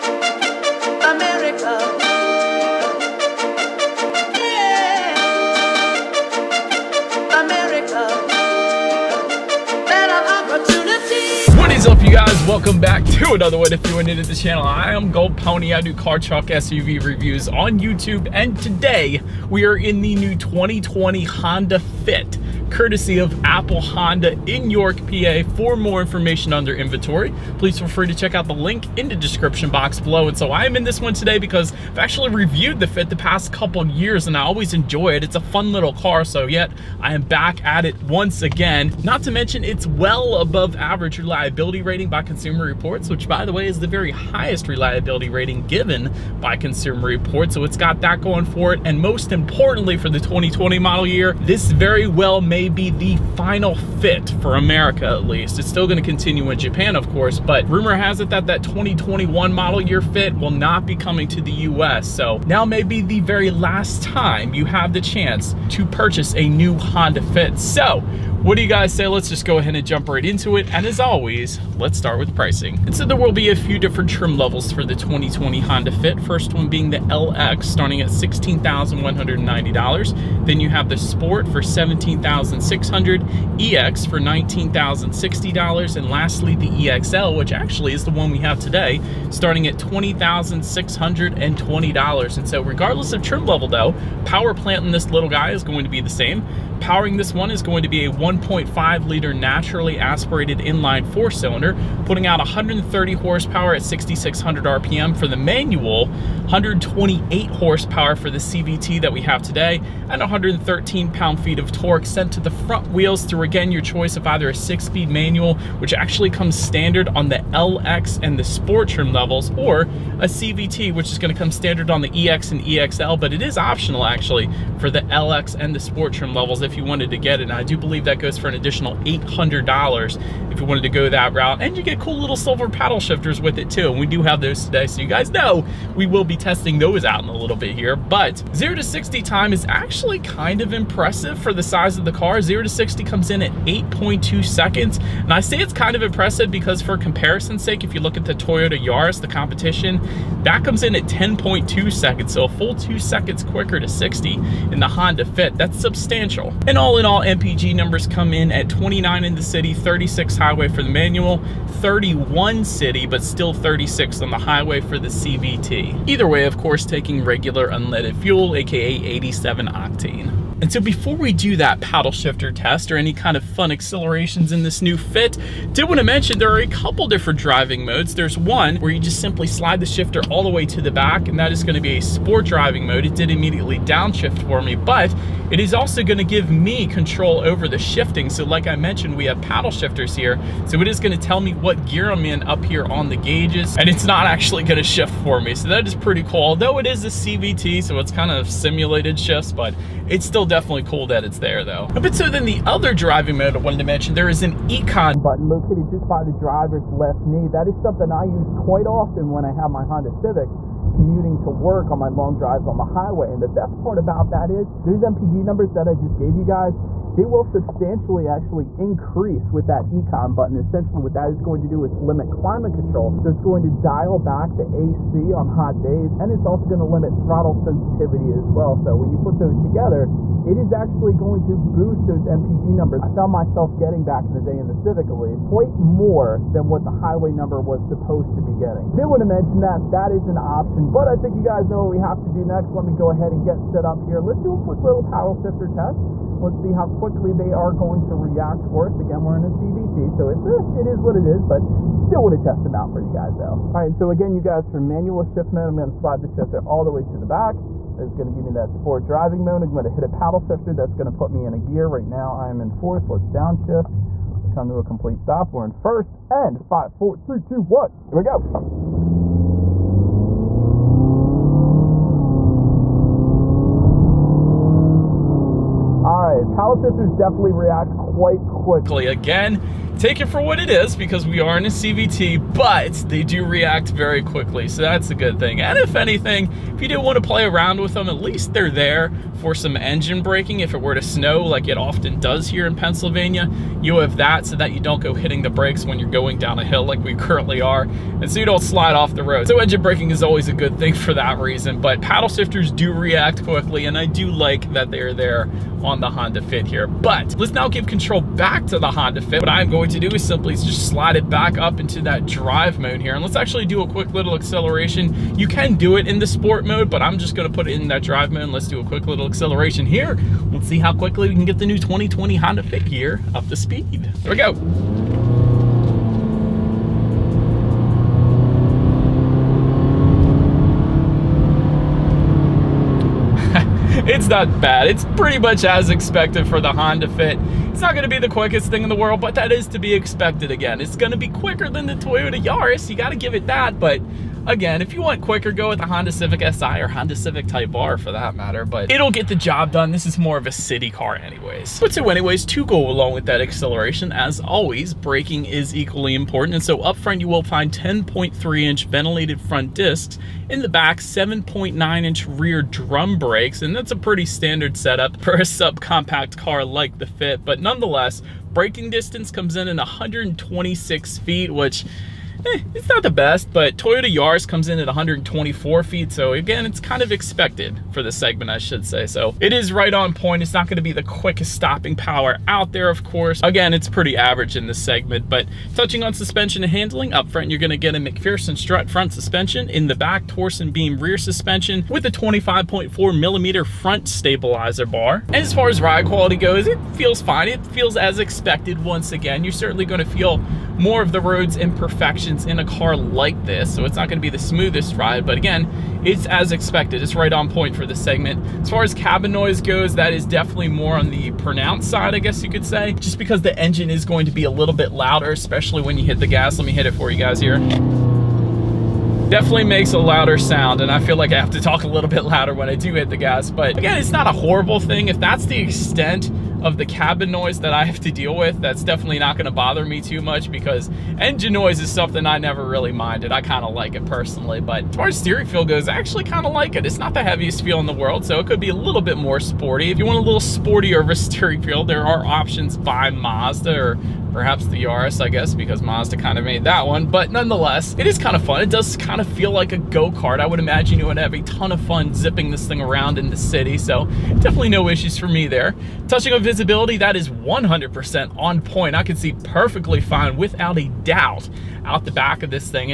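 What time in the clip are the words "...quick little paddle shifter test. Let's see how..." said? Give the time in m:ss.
4:04.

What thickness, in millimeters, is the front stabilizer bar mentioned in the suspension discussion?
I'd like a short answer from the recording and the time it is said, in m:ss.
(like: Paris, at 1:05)
25.4 millimeters, at 6:32.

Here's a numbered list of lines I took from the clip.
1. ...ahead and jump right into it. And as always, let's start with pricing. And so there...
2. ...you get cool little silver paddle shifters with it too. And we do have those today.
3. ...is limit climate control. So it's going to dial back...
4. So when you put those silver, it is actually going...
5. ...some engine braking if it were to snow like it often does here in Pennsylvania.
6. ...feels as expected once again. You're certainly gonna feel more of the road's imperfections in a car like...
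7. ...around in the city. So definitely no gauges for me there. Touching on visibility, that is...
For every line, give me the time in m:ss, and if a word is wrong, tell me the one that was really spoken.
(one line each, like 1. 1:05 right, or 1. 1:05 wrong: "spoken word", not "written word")
1. 1:09 right
2. 2:11 right
3. 3:41 right
4. 3:48 wrong: "together", not "silver"
5. 4:49 right
6. 6:37 right
7. 7:32 wrong: "issues", not "gauges".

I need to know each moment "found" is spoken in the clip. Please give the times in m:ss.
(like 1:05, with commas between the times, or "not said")
3:53.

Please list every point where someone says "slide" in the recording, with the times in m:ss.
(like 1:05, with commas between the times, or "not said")
2:59, 4:15, 4:58, 5:10.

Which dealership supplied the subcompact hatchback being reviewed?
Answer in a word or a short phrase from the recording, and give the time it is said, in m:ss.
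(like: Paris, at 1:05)
Apple Honda, at 0:23.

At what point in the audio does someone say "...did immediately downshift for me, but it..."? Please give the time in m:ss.
3:03.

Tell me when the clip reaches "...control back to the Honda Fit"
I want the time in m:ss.
5:07.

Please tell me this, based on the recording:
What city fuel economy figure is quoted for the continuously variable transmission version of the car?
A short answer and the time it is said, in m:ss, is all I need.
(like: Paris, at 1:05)
31, at 2:41.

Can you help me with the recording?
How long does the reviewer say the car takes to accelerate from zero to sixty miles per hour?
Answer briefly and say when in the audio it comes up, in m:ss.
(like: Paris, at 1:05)
8.2 seconds, at 2:23.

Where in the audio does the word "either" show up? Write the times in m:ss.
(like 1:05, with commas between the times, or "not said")
1:54, 2:46.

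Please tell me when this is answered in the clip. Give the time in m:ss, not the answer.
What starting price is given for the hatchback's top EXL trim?
1:29.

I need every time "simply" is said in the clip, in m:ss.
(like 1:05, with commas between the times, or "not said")
2:59, 5:10.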